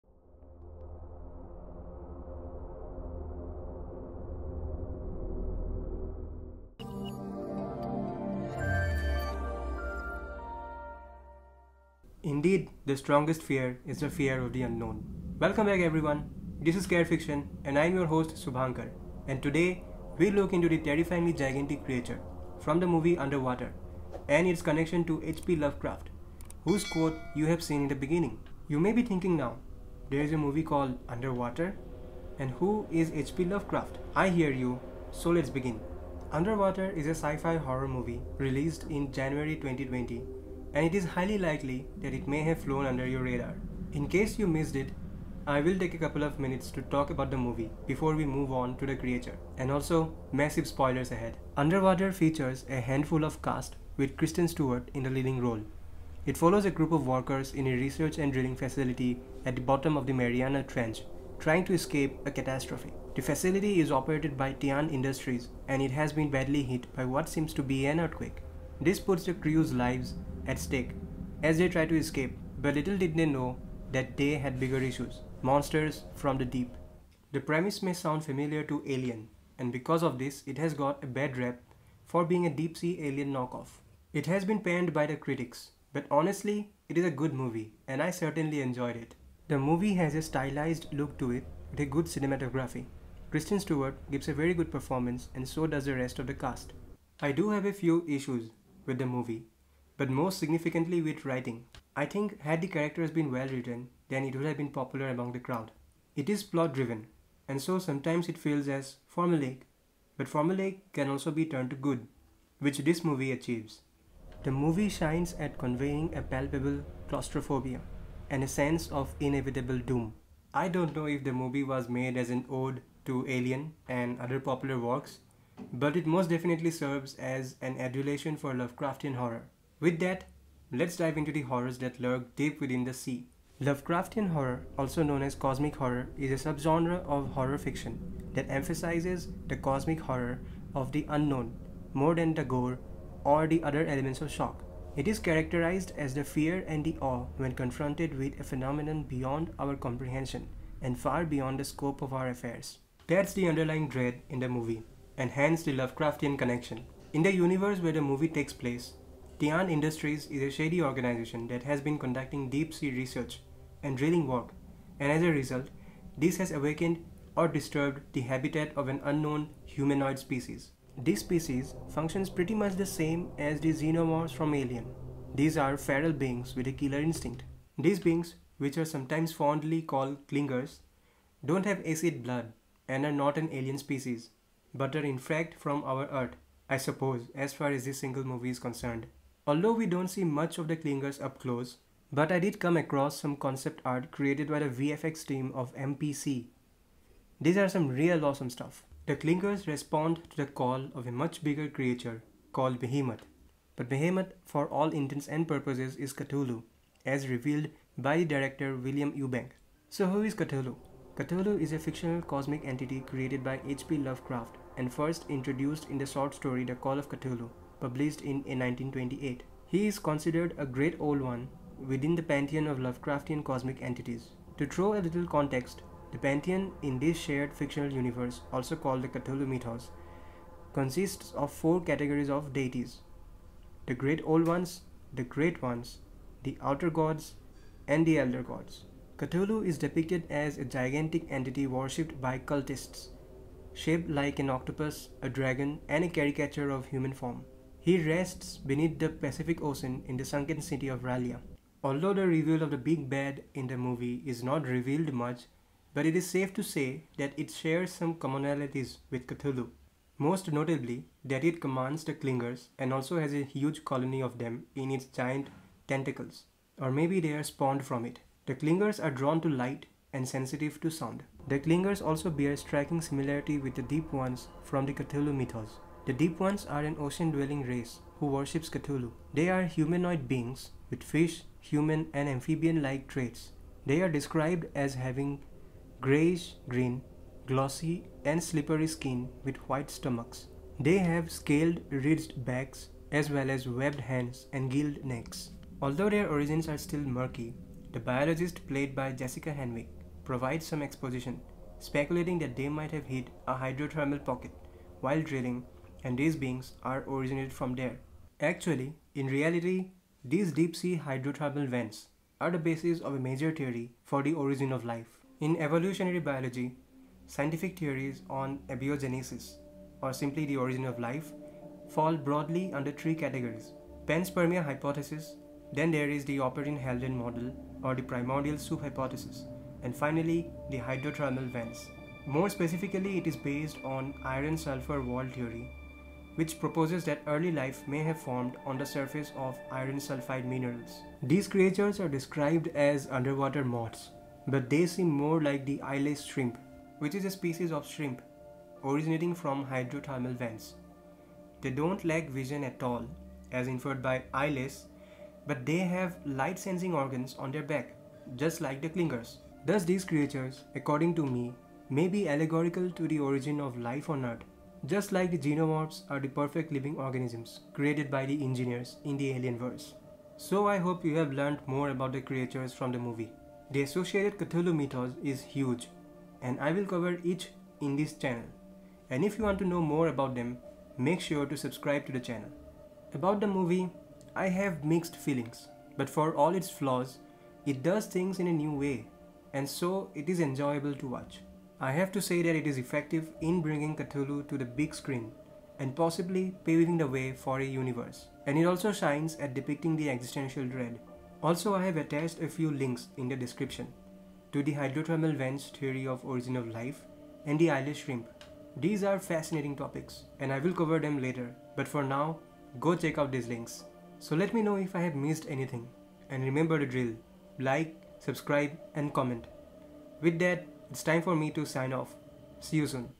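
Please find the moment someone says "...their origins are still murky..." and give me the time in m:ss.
4:56.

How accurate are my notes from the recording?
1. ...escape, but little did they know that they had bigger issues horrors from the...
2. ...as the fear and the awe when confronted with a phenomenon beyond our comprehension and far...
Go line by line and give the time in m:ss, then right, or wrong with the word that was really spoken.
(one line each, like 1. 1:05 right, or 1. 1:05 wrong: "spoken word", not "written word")
1. 1:11 wrong: "monsters", not "horrors"
2. 2:25 right.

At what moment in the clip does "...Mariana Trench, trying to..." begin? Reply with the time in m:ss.
1:00.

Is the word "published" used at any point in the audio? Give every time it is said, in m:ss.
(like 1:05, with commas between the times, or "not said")
3:37.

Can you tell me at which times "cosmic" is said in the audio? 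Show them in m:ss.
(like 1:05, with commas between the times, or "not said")
2:15, 2:19, 3:32, 3:43.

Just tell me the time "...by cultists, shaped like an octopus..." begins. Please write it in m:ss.
4:02.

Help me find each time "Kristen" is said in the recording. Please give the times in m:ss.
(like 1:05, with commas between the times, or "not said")
0:54, 1:33.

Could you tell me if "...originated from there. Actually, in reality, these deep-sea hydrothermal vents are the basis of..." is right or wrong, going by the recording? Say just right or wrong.
right.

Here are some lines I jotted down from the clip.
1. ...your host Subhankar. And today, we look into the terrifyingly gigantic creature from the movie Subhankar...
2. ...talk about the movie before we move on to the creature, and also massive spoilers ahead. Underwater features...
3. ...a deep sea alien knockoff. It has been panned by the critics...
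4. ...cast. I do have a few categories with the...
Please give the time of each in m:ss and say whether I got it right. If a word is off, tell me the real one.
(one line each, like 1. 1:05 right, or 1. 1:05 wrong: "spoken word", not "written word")
1. 0:17 wrong: "Underwater", not "Subhankar"
2. 0:46 right
3. 1:22 right
4. 1:36 wrong: "issues", not "categories".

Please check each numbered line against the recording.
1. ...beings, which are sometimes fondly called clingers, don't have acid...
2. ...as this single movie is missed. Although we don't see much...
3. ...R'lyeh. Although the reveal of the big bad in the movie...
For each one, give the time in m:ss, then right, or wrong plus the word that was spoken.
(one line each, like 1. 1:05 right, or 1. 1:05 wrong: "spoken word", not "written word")
1. 2:57 right
2. 3:07 wrong: "concerned", not "missed"
3. 4:11 right.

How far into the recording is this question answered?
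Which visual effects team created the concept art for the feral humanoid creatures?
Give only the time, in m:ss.
3:15.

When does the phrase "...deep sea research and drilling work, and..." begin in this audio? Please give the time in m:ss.
2:42.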